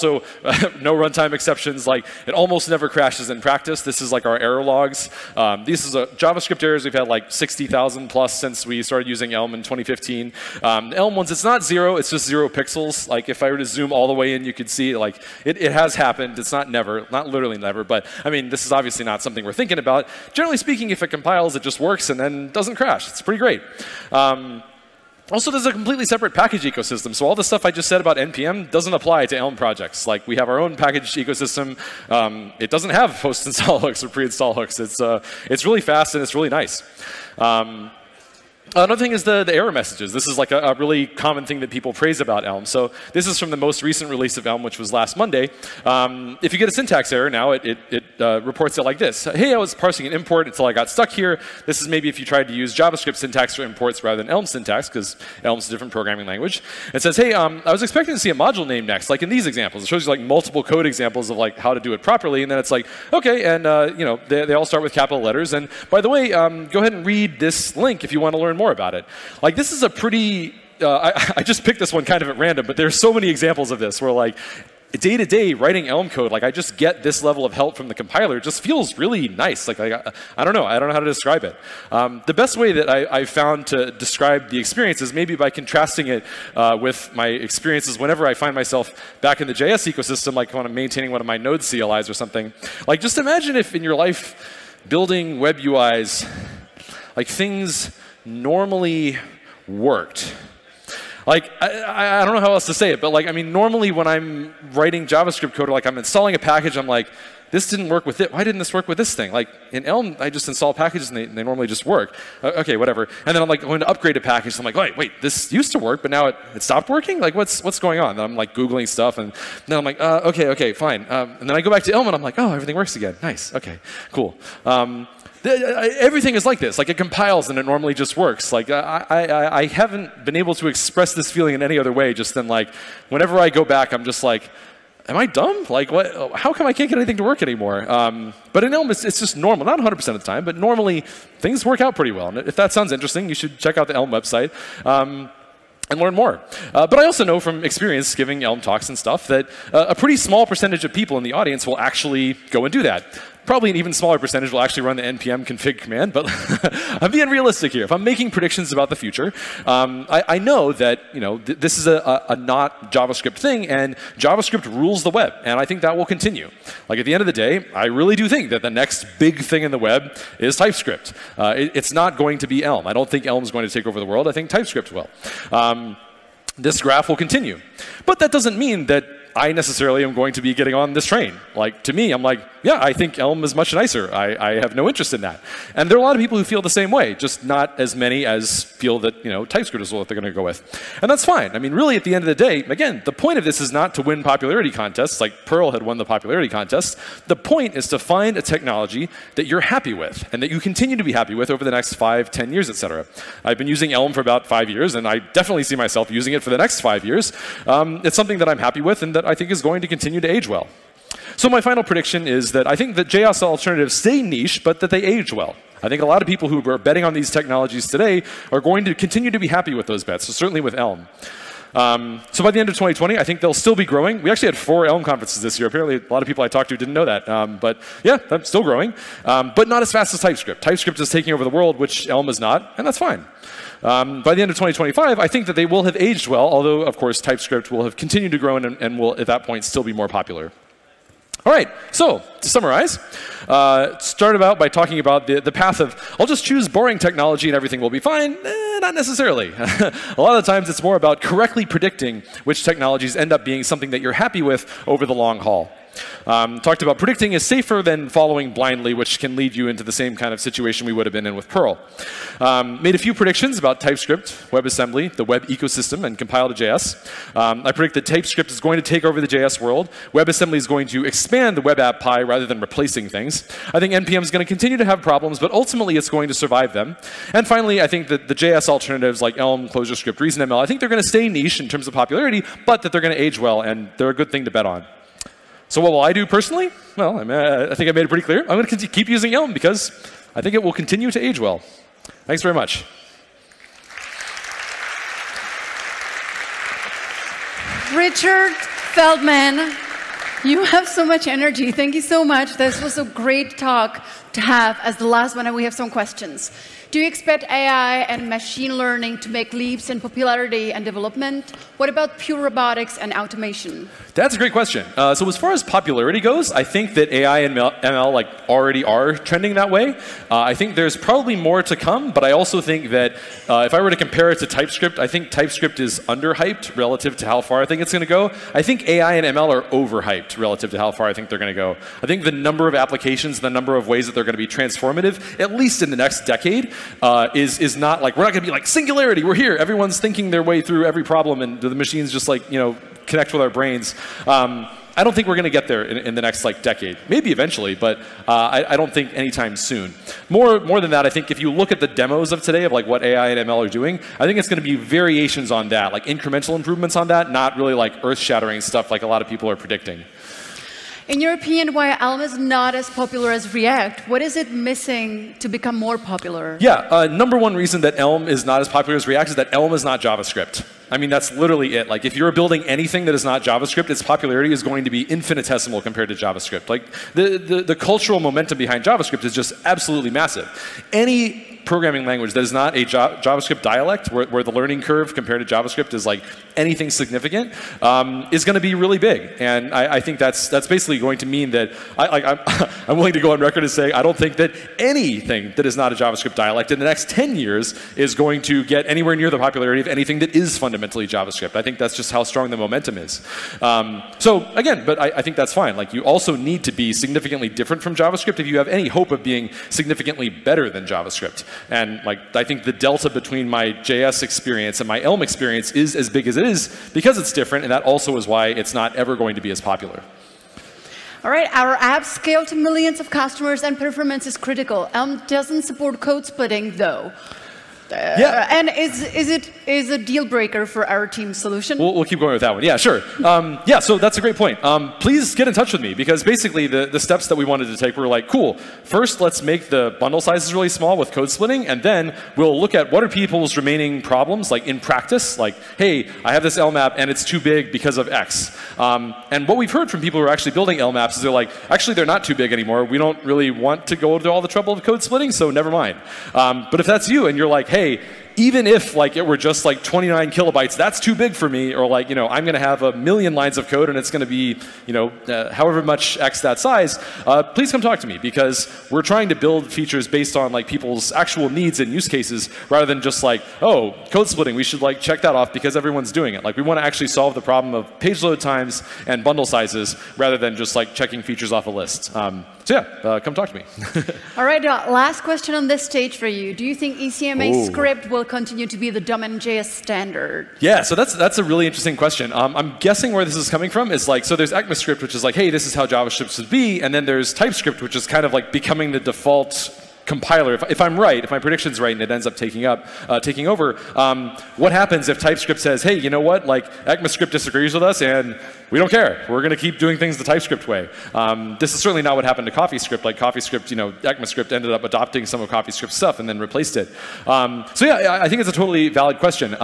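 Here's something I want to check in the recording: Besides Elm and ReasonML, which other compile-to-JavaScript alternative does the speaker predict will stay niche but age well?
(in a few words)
ClojureScript.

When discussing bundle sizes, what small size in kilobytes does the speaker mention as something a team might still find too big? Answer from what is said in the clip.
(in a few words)
29 kilobytes.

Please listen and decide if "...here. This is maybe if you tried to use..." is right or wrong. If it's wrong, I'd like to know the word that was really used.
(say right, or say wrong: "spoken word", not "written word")
right.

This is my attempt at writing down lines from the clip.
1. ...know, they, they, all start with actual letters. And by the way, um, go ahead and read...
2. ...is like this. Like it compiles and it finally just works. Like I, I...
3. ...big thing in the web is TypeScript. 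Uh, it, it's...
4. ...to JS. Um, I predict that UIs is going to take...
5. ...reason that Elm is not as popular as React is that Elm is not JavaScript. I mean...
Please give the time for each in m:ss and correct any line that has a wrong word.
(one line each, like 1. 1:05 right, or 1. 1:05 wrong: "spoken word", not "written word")
1. 1:04 wrong: "capital", not "actual"
2. 2:06 wrong: "normally", not "finally"
3. 2:49 right
4. 4:26 wrong: "TypeScript", not "UIs"
5. 6:07 right.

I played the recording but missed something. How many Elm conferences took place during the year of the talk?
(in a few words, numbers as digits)
4.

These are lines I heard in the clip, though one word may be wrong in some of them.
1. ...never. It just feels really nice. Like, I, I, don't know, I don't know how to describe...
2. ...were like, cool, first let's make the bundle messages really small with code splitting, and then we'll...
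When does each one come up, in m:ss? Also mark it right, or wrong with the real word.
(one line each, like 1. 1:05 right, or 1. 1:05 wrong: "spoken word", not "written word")
1. 1:18 wrong: "compiler", not "never"
2. 7:17 wrong: "sizes", not "messages".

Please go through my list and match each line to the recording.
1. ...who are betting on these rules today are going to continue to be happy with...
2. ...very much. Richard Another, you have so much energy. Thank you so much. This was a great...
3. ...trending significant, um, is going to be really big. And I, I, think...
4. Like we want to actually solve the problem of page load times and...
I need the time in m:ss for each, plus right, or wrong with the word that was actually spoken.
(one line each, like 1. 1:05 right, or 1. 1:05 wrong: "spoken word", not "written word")
1. 3:36 wrong: "technologies", not "rules"
2. 4:52 wrong: "Feldman", not "Another"
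3. 6:26 wrong: "anything", not "trending"
4. 7:56 right.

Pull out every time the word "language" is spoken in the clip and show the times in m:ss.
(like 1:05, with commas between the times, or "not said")
0:56, 6:22.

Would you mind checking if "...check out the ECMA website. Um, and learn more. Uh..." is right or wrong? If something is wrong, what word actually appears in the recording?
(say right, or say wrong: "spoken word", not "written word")
wrong: "Elm", not "ECMA".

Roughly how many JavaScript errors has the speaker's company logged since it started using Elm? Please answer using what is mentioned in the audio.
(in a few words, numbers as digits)
60,000.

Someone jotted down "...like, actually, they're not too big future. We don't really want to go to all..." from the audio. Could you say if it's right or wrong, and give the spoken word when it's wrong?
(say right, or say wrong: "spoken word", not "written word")
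wrong: "anymore", not "future".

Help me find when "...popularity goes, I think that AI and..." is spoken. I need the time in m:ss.
5:15.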